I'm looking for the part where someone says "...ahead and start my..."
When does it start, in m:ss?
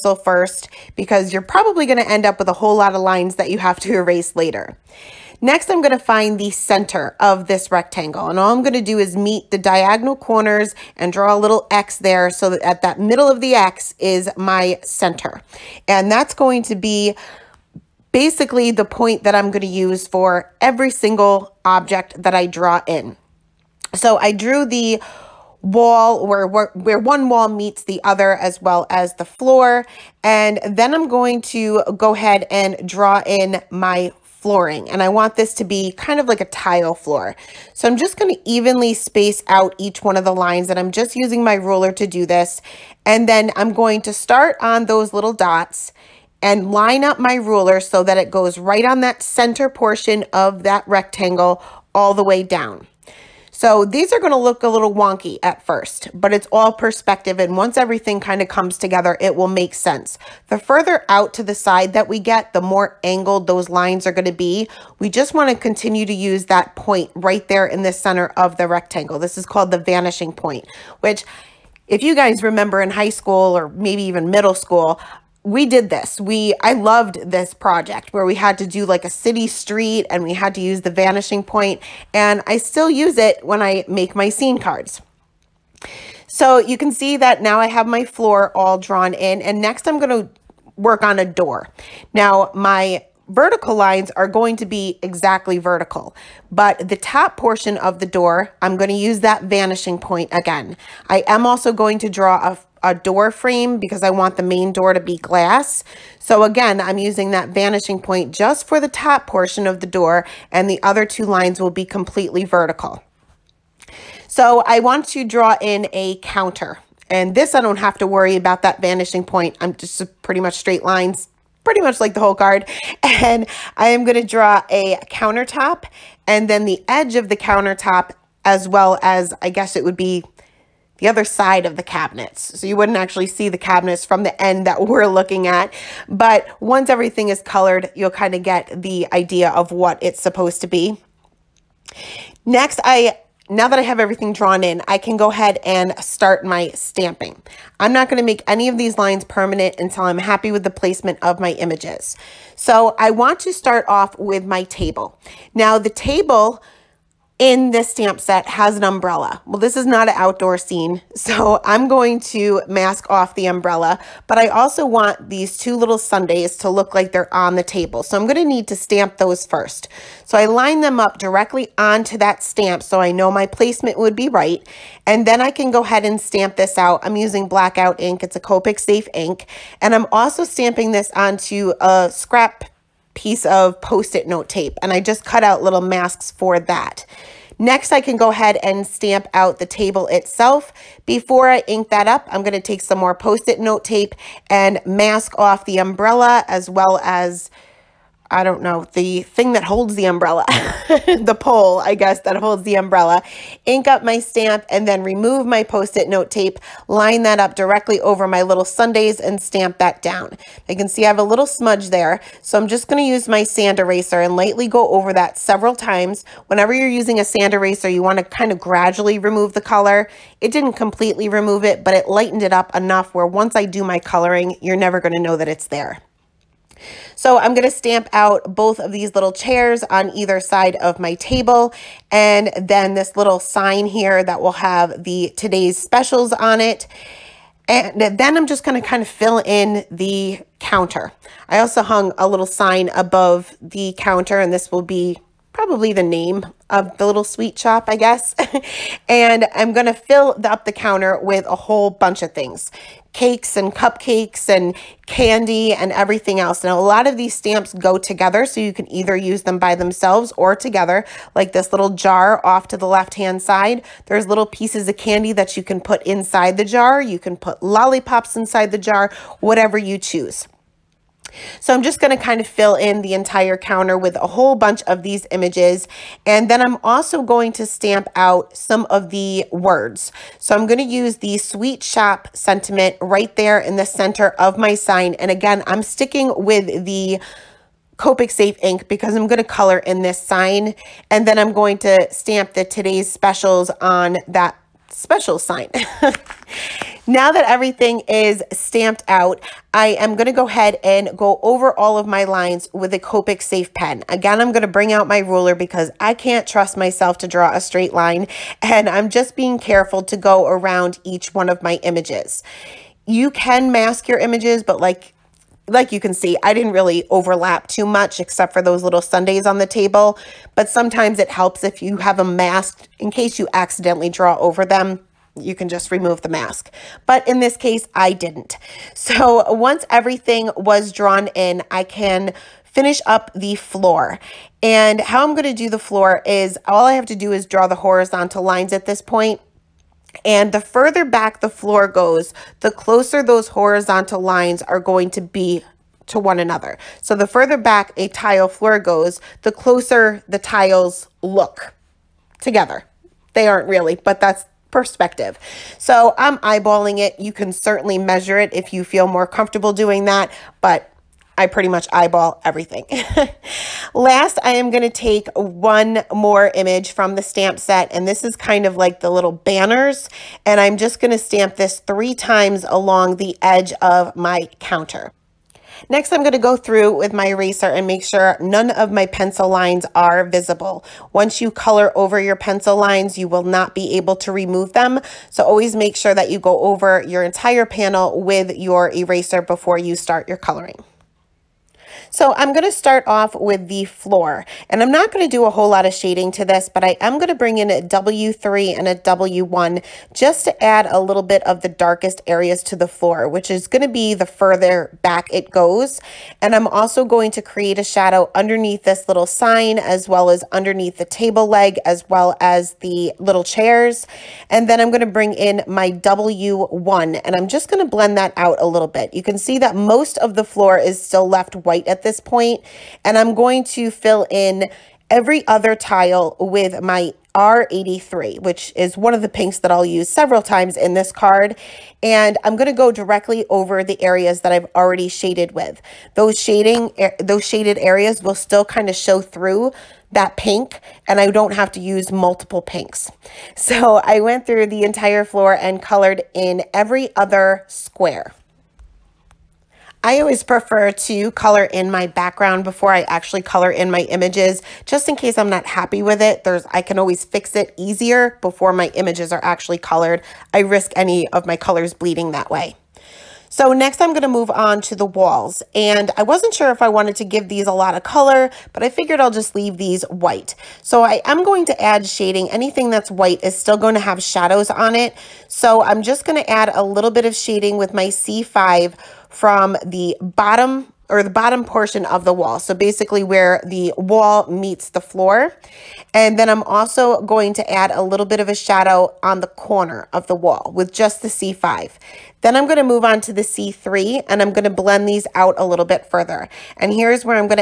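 2:25.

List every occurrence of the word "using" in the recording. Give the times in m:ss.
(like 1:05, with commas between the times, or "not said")
0:41, 1:46, 2:57, 3:36.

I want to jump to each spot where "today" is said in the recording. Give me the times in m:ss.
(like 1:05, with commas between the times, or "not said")
3:55, 4:52.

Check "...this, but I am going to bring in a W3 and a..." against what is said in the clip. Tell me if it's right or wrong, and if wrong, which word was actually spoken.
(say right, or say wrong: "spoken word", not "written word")
right.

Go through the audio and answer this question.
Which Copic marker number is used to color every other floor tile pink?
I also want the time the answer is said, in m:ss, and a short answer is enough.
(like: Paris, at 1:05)
R83, at 7:07.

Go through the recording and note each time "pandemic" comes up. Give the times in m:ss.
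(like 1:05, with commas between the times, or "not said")
not said.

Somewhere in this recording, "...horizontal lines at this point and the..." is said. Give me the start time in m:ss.
5:37.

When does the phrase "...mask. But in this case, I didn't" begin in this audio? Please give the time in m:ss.
5:26.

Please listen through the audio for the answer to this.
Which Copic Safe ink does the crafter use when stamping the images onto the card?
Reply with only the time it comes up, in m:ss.
2:57.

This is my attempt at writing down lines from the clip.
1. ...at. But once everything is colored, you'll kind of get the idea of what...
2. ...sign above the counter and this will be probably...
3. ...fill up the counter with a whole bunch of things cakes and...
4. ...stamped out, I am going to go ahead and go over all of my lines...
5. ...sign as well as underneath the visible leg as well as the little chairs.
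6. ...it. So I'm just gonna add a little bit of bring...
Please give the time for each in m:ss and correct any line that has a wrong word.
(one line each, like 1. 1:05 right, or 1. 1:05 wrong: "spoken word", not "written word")
1. 2:15 right
2. 4:02 right
3. 4:09 right
4. 4:58 right
5. 6:49 wrong: "table", not "visible"
6. 7:54 wrong: "shading", not "bring".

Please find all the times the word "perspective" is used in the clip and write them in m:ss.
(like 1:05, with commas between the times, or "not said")
0:56, 5:54.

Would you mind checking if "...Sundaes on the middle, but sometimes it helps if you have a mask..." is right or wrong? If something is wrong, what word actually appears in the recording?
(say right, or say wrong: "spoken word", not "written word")
wrong: "table", not "middle".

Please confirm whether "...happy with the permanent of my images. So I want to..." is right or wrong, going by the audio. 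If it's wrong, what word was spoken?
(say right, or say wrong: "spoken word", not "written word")
wrong: "placement", not "permanent".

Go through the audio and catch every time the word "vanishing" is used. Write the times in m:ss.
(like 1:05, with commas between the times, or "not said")
1:09, 1:20, 1:39, 1:47, 1:58.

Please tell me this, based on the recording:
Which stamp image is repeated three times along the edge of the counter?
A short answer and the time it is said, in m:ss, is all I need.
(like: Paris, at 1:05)
banners, at 6:09.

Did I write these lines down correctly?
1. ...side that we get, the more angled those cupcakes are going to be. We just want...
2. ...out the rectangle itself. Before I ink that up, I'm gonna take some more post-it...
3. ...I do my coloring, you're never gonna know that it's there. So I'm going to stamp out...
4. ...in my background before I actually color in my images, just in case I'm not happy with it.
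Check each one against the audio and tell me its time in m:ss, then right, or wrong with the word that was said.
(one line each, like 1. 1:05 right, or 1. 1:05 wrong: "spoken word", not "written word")
1. 1:01 wrong: "lines", not "cupcakes"
2. 3:09 wrong: "table", not "rectangle"
3. 3:43 right
4. 7:31 right.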